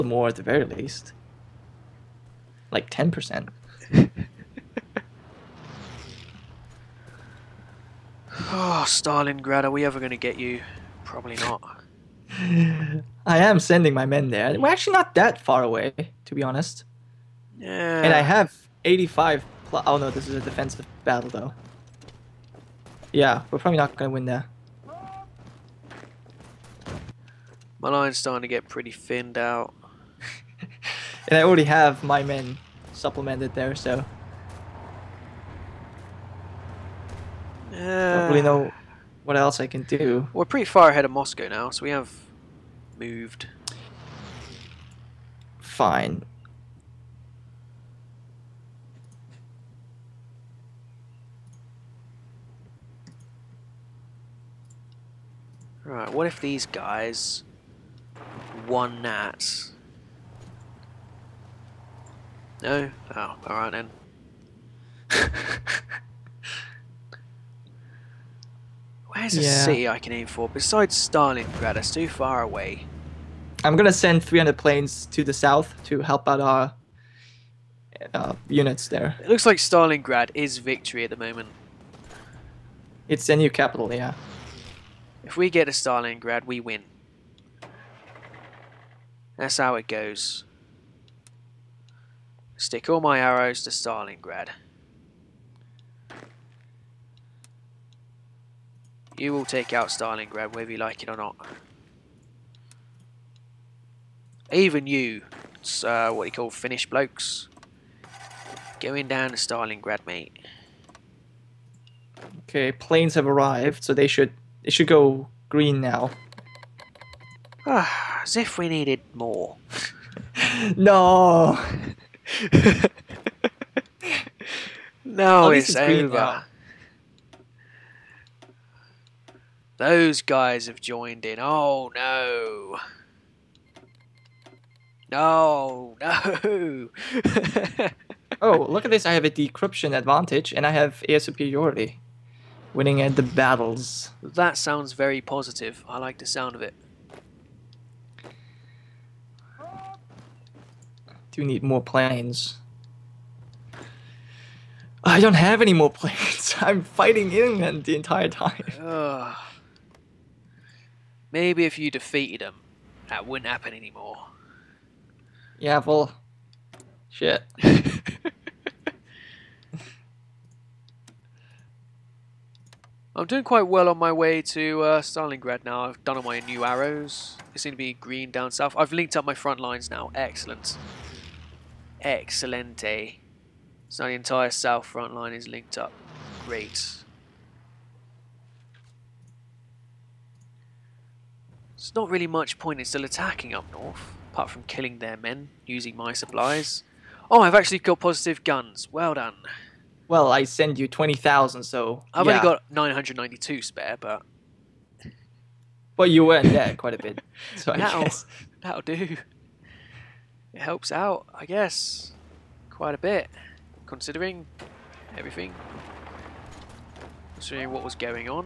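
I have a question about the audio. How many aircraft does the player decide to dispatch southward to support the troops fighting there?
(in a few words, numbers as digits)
300.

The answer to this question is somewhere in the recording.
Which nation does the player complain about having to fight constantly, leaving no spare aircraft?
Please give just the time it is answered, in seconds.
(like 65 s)
157 s.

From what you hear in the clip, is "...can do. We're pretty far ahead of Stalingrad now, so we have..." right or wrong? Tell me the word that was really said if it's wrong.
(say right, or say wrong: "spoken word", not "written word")
wrong: "Moscow", not "Stalingrad".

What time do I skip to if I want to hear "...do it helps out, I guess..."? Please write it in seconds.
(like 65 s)
208 s.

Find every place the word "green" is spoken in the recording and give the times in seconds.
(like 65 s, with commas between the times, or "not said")
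115 s, 177 s.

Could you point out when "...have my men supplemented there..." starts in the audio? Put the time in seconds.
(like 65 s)
31 s.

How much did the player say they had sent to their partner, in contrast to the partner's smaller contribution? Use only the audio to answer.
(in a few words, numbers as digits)
20,000.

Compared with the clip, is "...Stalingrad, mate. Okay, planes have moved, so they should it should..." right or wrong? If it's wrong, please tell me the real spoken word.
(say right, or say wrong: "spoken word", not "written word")
wrong: "arrived", not "moved".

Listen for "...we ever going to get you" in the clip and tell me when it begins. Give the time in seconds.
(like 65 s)
9 s.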